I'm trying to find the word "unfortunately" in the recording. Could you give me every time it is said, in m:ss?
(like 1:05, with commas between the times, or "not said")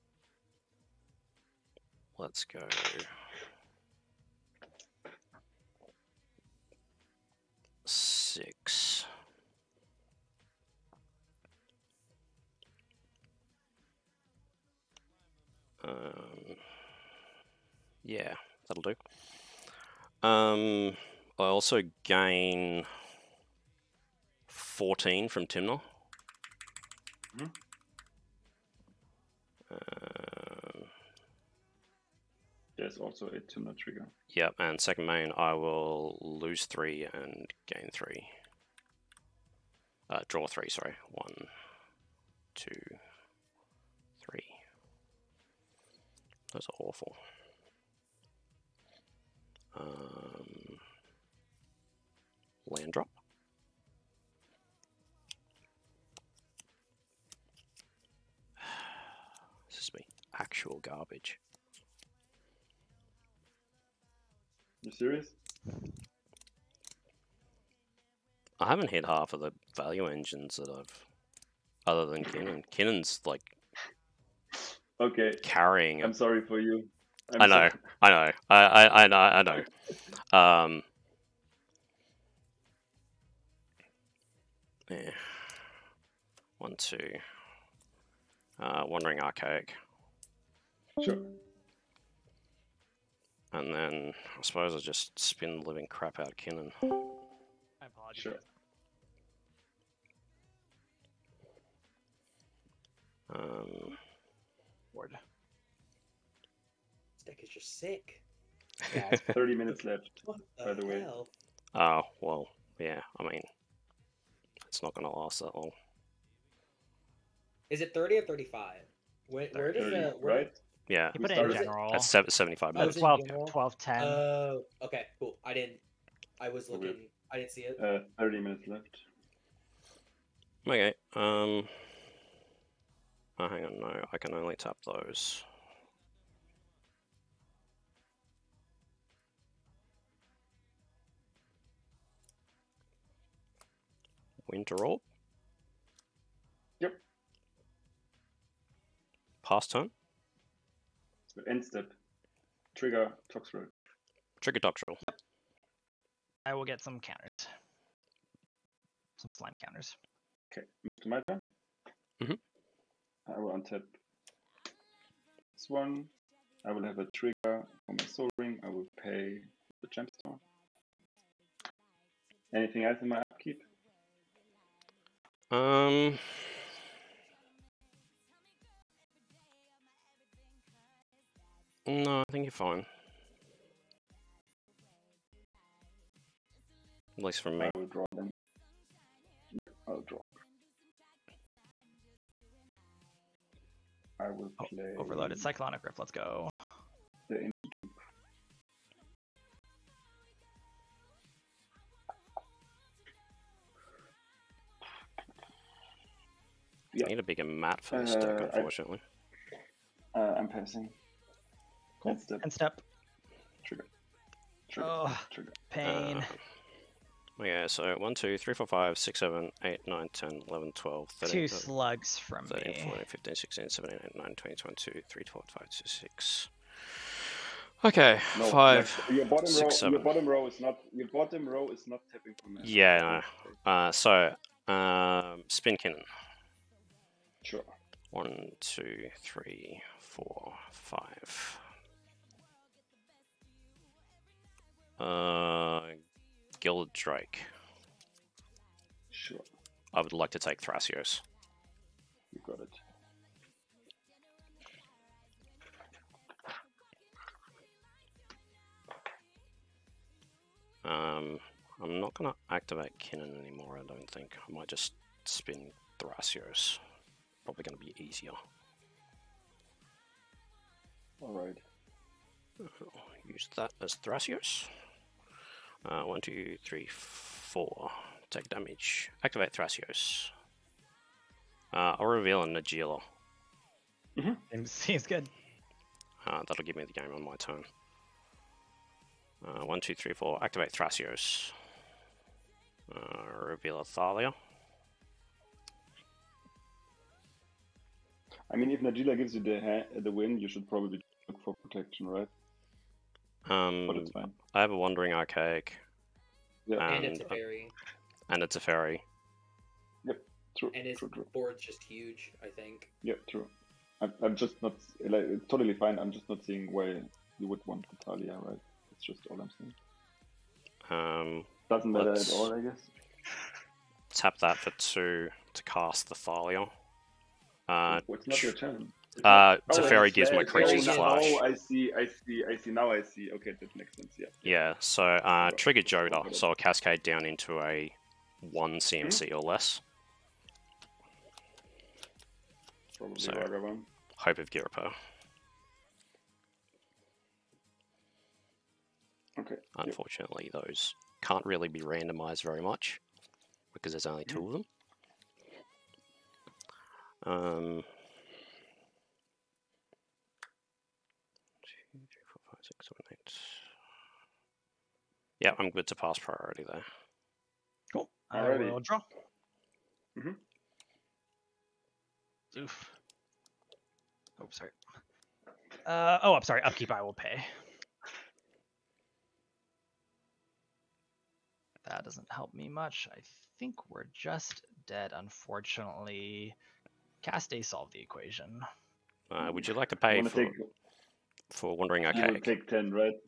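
3:28, 5:49, 6:25.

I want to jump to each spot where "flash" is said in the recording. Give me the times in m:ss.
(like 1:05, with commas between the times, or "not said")
5:30.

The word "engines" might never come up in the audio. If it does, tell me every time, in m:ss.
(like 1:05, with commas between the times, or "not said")
1:10.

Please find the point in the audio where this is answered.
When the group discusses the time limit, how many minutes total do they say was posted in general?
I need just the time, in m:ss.
2:02.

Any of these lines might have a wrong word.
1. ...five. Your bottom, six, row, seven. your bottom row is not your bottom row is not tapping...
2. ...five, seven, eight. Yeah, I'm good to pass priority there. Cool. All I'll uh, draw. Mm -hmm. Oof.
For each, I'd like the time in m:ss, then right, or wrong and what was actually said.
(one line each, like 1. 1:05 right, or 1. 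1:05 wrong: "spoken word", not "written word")
1. 3:48 right
2. 6:02 wrong: "six", not "five".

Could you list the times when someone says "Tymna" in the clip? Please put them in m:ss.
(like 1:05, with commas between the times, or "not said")
0:25, 0:33.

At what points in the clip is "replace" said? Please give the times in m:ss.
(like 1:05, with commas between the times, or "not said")
not said.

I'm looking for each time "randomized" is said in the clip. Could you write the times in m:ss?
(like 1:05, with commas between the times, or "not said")
5:51.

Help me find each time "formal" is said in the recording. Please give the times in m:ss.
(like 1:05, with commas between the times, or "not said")
not said.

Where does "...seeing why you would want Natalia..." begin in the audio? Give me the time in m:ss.
5:16.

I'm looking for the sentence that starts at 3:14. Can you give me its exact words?
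Oh, overloaded Cyclonic Rift, let's go.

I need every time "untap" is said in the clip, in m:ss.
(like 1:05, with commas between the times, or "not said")
2:43.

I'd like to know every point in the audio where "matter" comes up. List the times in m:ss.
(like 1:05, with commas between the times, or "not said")
5:21.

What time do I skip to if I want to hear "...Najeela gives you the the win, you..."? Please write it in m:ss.
4:58.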